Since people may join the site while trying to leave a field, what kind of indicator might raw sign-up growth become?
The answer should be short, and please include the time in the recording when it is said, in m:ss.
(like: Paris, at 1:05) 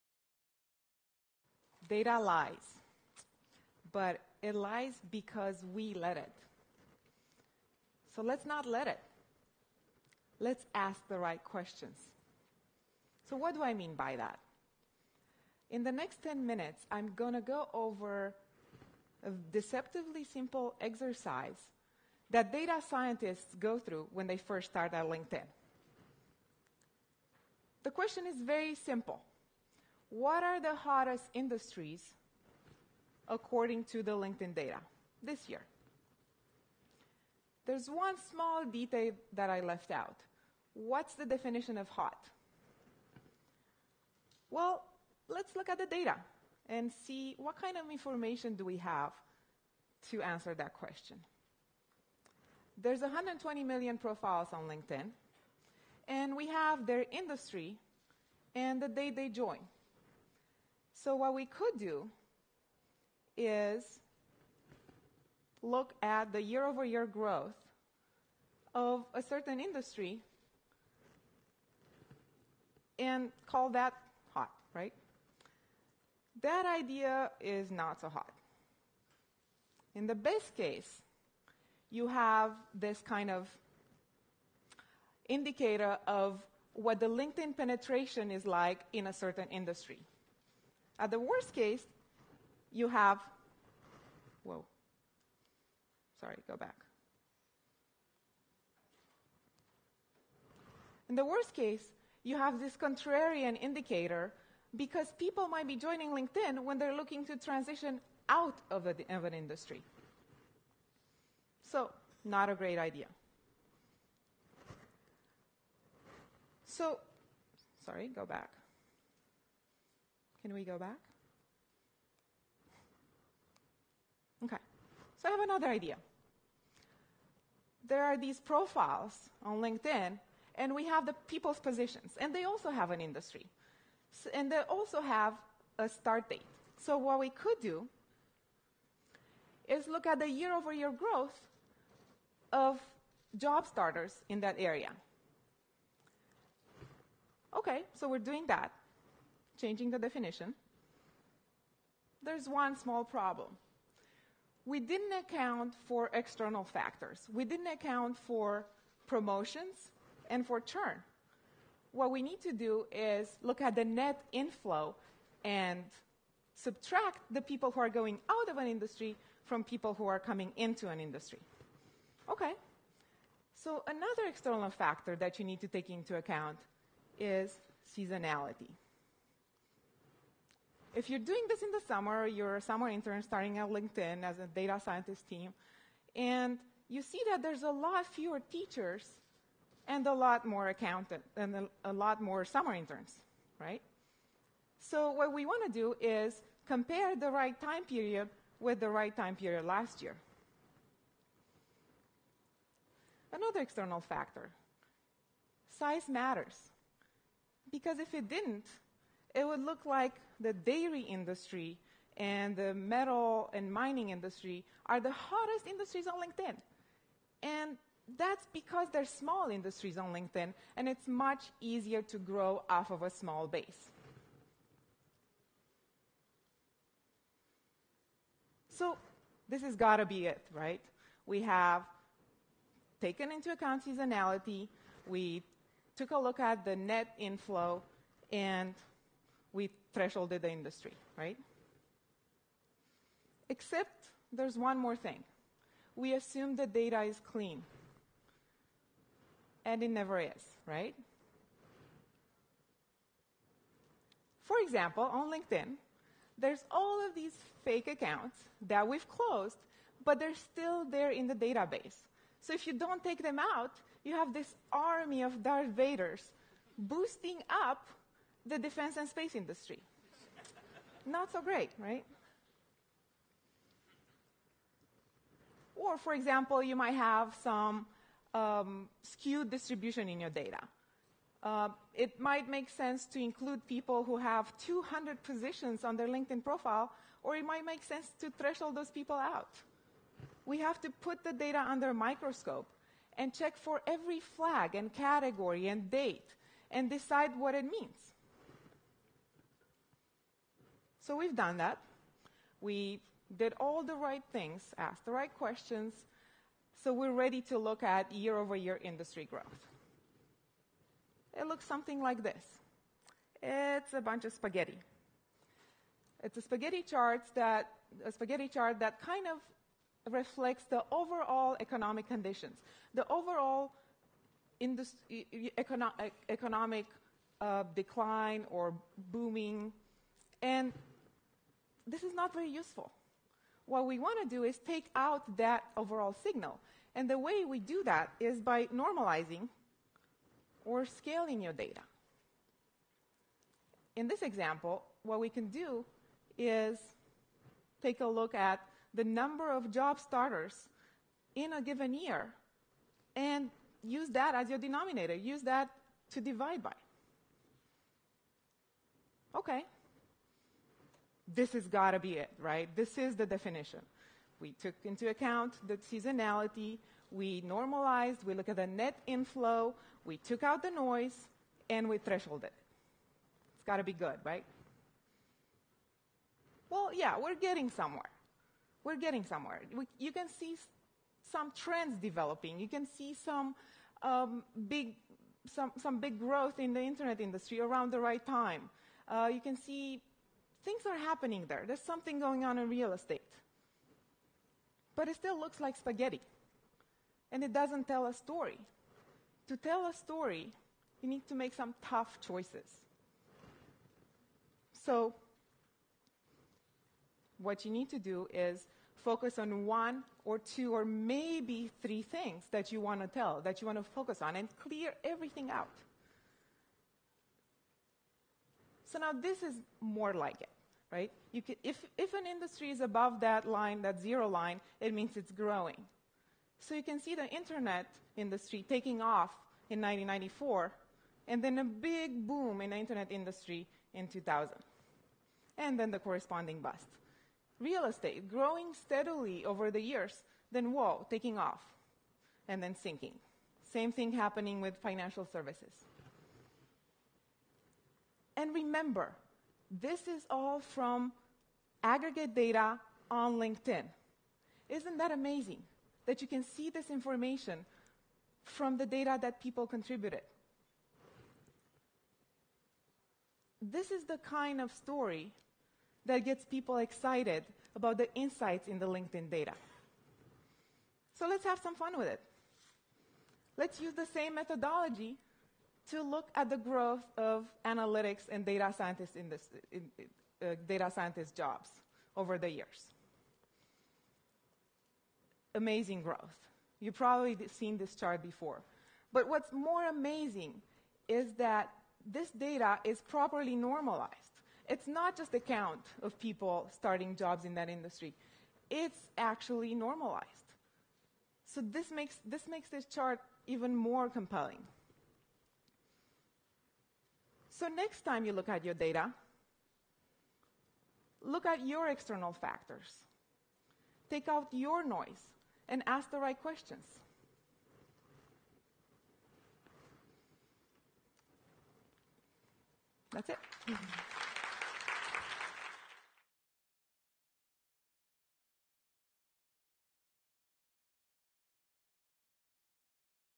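contrarian indicator, at 1:42.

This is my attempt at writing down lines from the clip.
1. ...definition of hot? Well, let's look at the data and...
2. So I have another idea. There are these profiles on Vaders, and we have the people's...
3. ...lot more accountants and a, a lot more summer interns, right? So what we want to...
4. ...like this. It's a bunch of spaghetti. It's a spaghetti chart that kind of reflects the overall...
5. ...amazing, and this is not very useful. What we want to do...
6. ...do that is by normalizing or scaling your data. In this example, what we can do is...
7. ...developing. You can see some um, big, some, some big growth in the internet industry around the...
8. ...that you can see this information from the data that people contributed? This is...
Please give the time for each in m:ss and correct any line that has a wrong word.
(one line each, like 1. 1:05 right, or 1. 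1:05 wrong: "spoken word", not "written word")
1. 0:41 right
2. 2:05 wrong: "LinkedIn", not "Vaders"
3. 3:10 right
4. 5:12 right
5. 5:29 wrong: "booming", not "amazing"
6. 5:37 right
7. 6:21 right
8. 7:36 right.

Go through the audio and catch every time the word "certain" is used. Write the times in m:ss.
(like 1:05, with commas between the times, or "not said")
1:09, 1:29.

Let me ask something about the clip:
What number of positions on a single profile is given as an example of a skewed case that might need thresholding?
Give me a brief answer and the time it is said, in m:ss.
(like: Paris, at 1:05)
200, at 4:44.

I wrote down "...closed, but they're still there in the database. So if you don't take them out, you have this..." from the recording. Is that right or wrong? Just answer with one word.
right.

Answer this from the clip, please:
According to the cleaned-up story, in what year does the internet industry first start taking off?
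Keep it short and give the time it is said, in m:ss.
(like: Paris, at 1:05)
1994, at 7:09.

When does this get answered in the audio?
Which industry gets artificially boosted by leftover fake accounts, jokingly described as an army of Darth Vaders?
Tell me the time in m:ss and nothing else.
4:28.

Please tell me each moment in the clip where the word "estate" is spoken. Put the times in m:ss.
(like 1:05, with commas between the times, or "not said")
6:32, 7:17.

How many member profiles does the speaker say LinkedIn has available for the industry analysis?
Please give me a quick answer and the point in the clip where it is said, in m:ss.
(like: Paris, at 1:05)
120 million, at 0:52.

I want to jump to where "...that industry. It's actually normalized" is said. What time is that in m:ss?
8:17.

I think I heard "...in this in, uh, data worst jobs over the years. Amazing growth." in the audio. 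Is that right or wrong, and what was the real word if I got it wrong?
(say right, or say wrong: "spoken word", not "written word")
wrong: "scientist", not "worst".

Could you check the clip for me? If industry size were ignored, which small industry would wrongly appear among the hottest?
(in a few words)
dairy.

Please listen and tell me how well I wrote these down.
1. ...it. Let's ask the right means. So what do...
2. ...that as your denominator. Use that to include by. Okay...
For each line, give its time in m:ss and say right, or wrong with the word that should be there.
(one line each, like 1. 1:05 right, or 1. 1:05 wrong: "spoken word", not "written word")
1. 0:08 wrong: "questions", not "means"
2. 5:54 wrong: "divide", not "include".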